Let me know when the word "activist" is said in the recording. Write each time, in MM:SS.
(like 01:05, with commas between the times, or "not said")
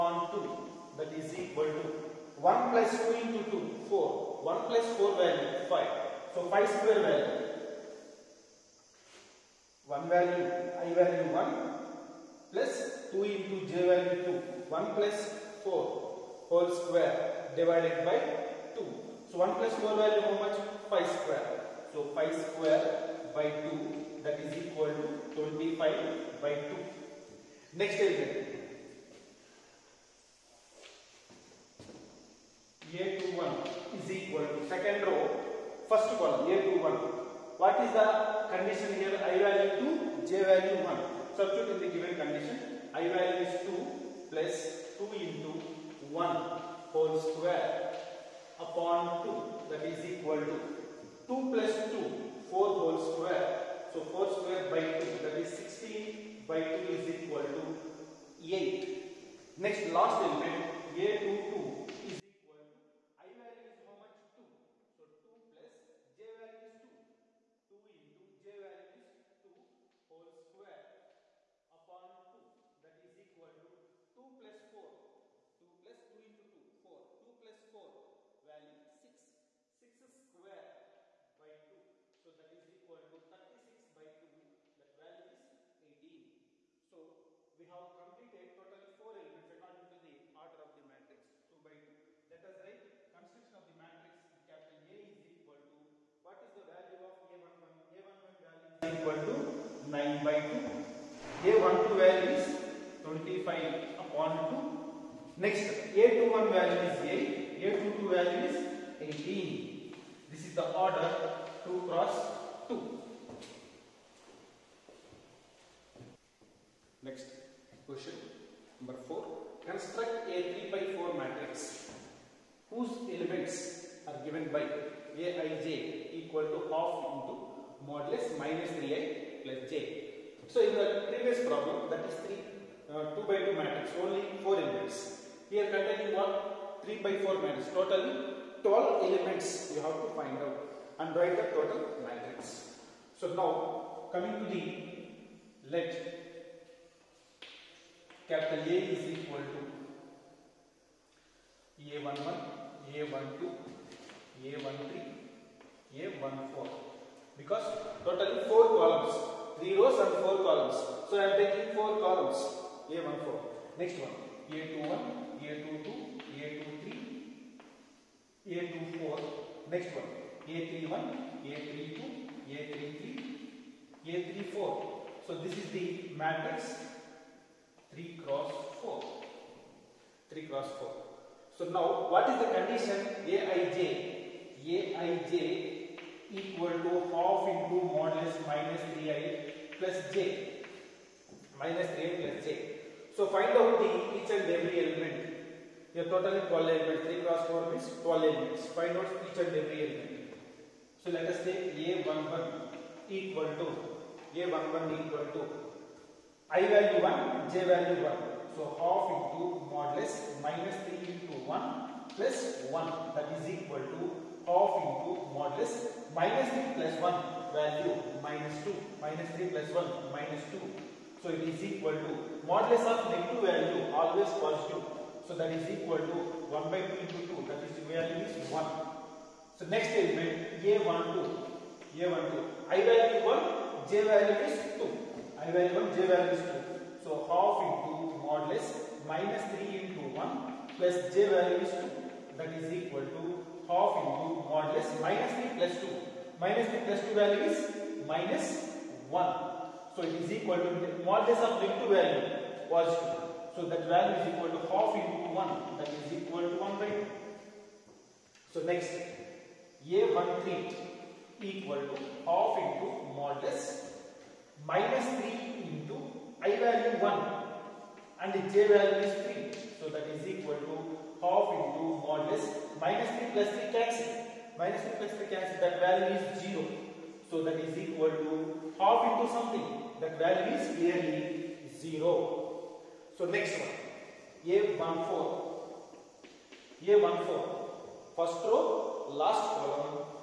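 not said.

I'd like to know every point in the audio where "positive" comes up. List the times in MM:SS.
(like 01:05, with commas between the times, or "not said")
03:44.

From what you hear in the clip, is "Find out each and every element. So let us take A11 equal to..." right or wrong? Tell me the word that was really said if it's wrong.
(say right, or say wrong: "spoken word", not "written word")
right.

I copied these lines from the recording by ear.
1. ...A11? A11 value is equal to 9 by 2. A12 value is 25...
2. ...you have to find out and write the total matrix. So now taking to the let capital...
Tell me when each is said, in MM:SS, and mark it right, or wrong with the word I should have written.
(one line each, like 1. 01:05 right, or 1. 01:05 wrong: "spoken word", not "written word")
1. 01:37 right
2. 02:19 wrong: "coming", not "taking".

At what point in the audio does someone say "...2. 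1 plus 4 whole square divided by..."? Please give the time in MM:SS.
00:14.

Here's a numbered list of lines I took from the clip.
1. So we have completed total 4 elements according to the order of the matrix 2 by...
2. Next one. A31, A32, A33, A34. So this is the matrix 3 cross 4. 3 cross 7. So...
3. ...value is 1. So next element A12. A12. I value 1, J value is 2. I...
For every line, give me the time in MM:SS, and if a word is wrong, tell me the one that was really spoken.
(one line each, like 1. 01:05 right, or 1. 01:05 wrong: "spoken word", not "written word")
1. 01:26 right
2. 02:49 wrong: "4", not "7"
3. 03:47 right.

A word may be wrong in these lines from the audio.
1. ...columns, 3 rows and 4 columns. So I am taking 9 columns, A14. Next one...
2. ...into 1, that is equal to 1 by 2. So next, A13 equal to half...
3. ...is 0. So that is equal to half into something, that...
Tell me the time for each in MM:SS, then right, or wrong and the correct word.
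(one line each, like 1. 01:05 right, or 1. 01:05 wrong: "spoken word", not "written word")
1. 02:38 wrong: "4", not "9"
2. 04:14 right
3. 04:36 right.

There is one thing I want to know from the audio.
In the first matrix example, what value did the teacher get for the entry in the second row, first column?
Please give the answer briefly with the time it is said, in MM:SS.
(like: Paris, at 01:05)
8, at 00:55.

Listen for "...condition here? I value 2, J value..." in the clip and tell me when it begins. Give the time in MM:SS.
00:38.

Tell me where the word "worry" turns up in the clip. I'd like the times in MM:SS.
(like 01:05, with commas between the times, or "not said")
not said.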